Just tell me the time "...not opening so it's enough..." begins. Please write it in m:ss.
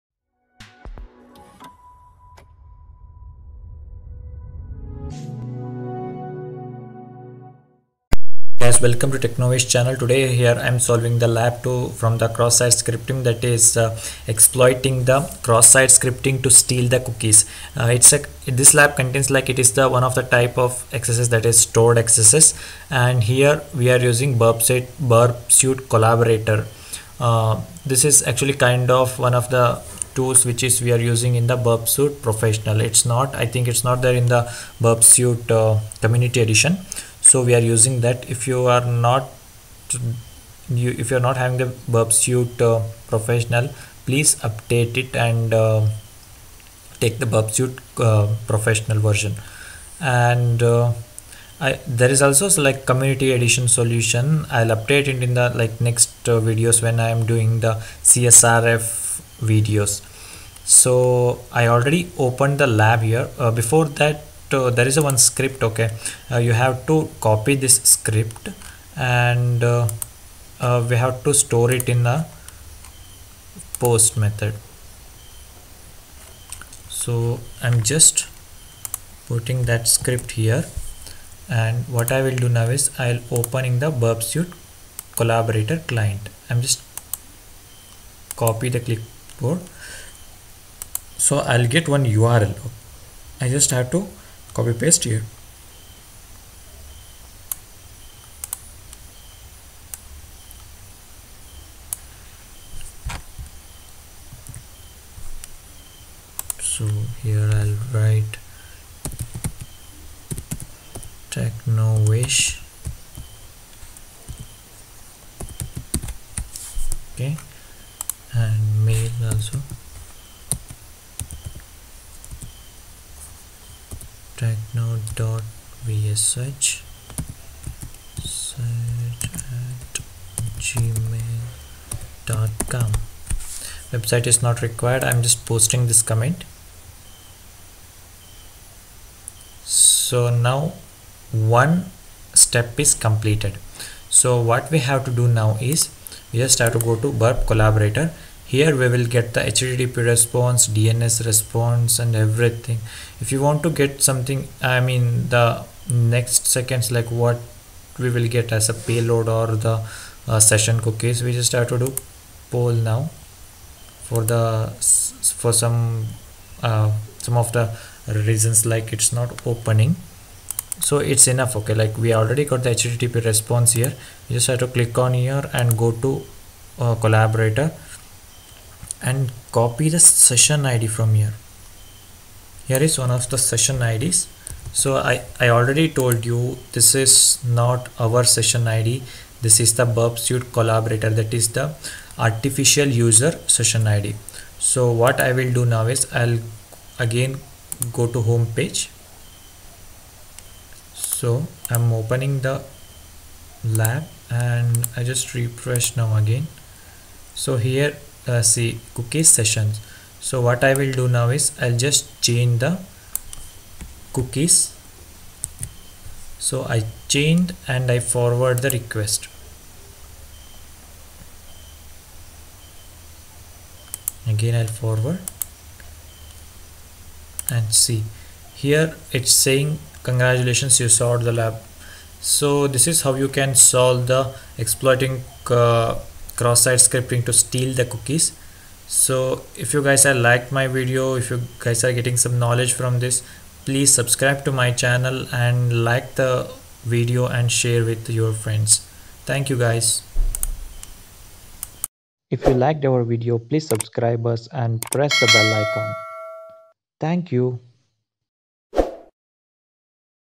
2:49.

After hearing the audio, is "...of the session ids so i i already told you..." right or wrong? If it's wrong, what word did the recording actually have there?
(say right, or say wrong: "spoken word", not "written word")
right.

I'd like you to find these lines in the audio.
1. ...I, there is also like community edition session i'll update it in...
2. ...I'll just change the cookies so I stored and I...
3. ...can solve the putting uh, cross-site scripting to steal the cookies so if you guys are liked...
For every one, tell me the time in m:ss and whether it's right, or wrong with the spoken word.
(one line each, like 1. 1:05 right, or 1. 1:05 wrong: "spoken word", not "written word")
1. 0:51 wrong: "solution", not "session"
2. 3:31 wrong: "changed", not "stored"
3. 3:53 wrong: "exploiting", not "putting".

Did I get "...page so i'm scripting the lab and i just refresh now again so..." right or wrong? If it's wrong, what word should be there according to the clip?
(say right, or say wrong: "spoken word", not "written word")
wrong: "opening", not "scripting".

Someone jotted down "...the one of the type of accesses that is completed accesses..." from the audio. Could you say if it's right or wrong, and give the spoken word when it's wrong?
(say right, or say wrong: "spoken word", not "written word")
wrong: "stored", not "completed".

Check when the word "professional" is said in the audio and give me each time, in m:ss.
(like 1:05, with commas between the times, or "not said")
0:32, 0:43, 0:48.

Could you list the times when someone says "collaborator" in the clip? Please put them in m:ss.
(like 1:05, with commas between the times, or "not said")
0:25, 1:25, 2:27, 2:57, 3:10.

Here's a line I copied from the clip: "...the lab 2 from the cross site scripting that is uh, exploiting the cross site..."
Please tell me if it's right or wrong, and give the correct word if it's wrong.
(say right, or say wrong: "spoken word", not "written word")
right.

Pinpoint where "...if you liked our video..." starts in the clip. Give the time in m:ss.
4:12.